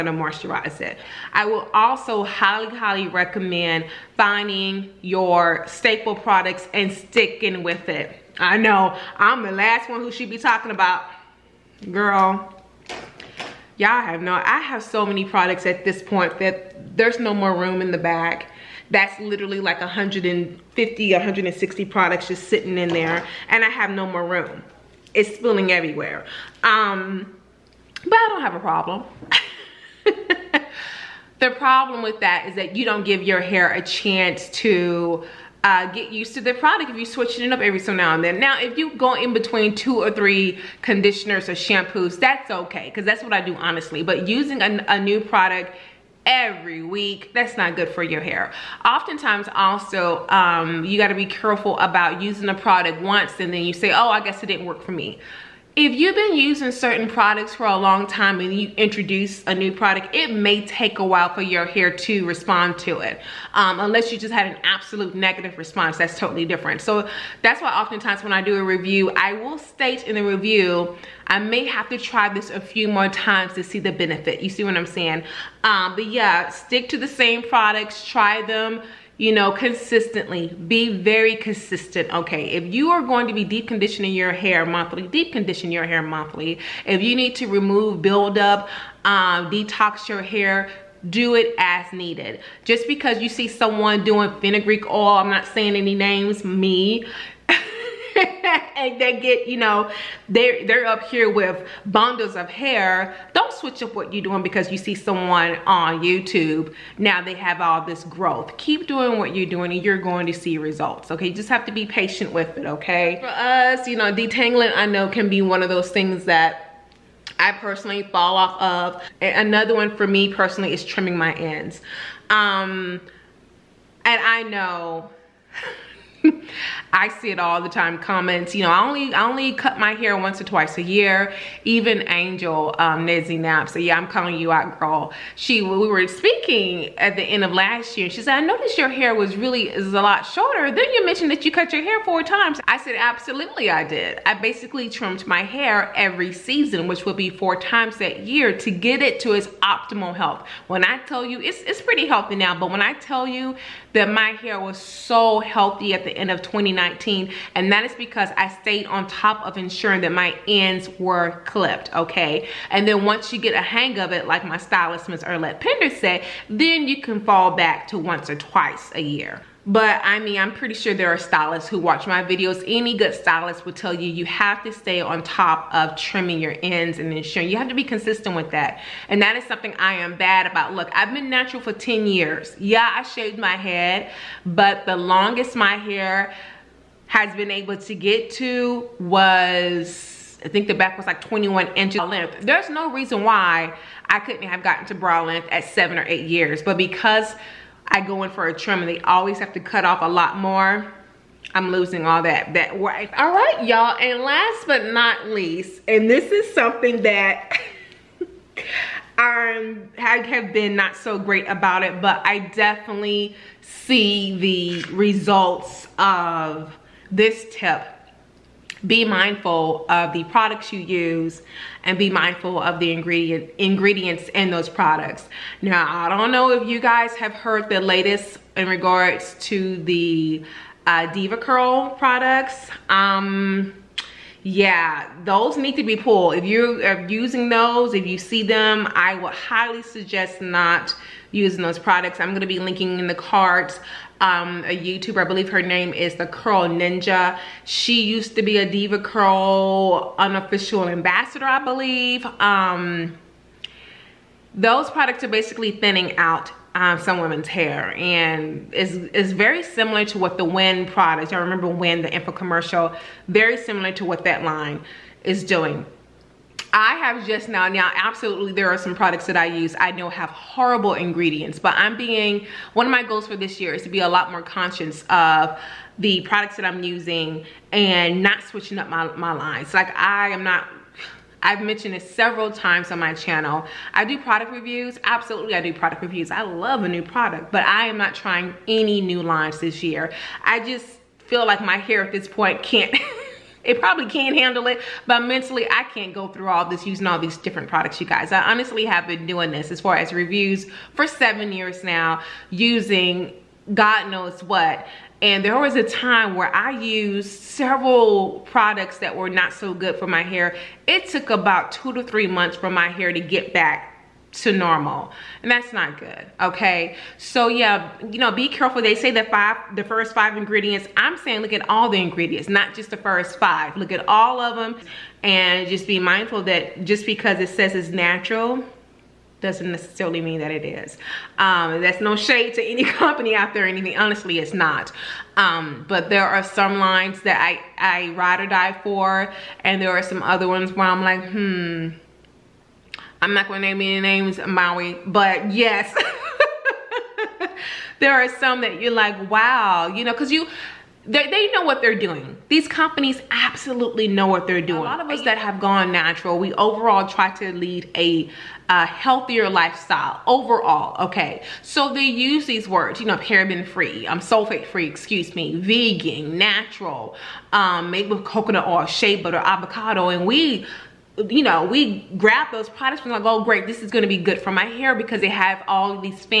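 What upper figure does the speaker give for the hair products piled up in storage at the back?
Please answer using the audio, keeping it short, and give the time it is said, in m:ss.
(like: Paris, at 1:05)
160, at 0:21.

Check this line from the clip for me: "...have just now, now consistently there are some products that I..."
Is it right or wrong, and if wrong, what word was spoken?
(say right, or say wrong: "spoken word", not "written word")
wrong: "absolutely", not "consistently".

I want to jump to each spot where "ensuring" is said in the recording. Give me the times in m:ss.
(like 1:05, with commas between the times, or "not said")
2:39, 2:57.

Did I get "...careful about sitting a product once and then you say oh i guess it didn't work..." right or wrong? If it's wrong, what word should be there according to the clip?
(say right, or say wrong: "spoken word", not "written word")
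wrong: "using", not "sitting".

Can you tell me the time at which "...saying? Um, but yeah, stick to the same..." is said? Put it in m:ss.
1:14.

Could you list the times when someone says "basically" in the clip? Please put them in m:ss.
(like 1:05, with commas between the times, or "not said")
2:24, 4:15.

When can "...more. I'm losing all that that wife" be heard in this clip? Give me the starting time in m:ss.
3:20.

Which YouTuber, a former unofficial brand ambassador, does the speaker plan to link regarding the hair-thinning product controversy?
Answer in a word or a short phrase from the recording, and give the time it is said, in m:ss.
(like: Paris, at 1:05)
the Curl Ninja, at 4:06.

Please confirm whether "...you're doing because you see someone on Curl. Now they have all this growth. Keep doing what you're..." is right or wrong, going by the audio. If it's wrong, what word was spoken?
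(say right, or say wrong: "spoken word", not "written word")
wrong: "YouTube", not "Curl".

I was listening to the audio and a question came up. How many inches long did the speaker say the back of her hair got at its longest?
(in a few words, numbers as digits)
21.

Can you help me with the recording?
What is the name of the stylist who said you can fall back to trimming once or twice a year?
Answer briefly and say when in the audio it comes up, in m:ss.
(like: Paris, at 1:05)
Erlette Pender, at 2:45.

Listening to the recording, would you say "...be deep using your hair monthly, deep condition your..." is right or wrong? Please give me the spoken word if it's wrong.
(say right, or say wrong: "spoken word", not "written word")
wrong: "conditioning", not "using".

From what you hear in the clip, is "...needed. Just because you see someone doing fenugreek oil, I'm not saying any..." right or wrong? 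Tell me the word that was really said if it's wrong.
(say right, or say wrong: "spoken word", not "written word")
right.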